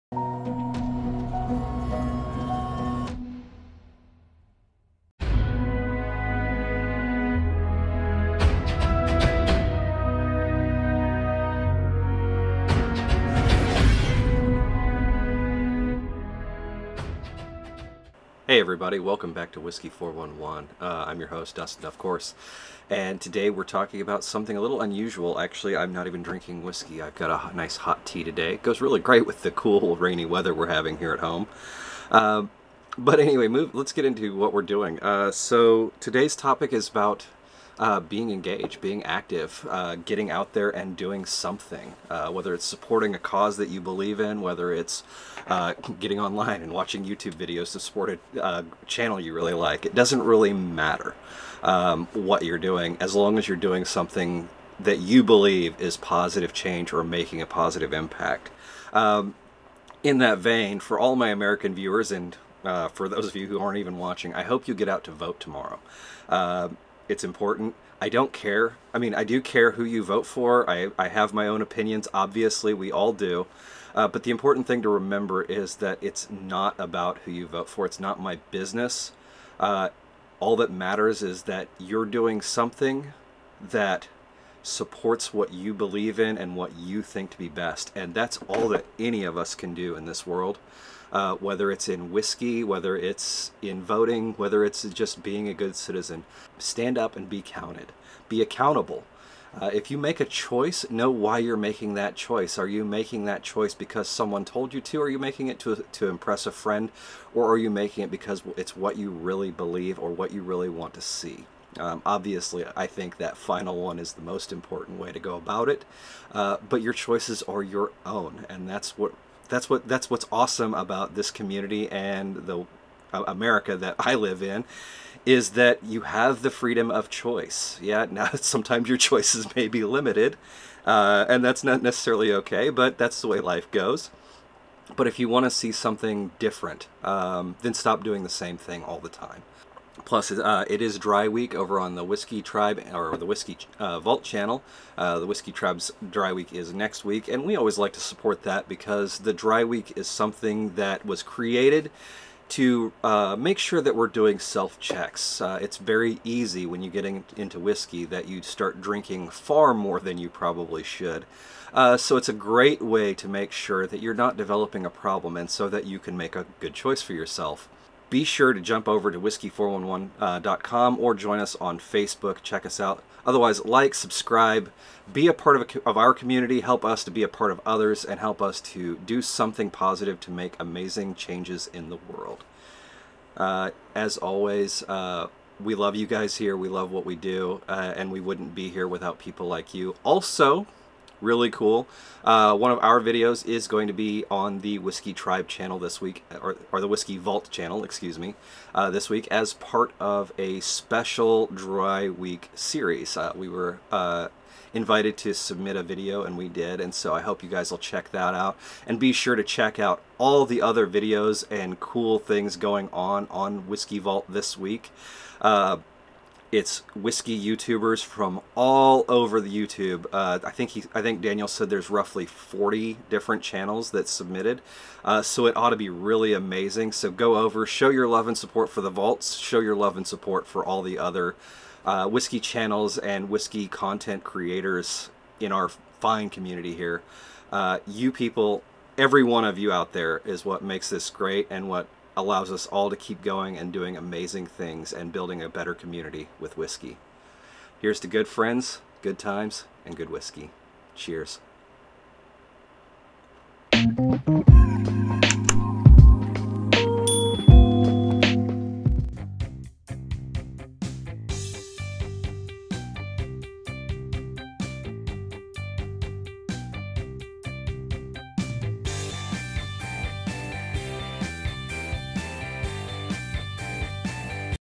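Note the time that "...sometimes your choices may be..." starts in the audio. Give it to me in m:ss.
2:08.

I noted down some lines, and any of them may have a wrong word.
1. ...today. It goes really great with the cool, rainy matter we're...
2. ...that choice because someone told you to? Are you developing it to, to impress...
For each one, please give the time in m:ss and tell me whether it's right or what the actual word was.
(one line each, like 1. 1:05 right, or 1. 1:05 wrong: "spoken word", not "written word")
1. 0:28 wrong: "weather", not "matter"
2. 1:43 wrong: "making", not "developing".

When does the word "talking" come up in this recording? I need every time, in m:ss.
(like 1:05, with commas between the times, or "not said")
0:23.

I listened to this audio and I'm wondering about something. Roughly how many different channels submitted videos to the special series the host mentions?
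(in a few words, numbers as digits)
40.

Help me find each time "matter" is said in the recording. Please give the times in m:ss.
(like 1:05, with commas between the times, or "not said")
0:50, 1:20.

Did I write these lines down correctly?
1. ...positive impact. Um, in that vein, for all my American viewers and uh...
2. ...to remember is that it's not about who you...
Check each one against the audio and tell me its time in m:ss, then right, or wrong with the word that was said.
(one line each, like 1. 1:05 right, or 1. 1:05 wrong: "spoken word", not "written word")
1. 0:57 right
2. 1:14 right.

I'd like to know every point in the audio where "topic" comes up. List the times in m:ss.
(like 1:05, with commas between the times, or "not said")
0:36.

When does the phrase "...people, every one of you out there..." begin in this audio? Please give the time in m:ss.
3:58.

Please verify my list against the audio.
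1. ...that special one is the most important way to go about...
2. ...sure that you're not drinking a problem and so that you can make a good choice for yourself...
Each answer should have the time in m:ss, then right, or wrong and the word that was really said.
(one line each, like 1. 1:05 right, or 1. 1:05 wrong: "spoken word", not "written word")
1. 1:53 wrong: "final", not "special"
2. 2:43 wrong: "developing", not "drinking".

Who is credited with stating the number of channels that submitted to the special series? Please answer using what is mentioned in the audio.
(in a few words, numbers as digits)
Daniel.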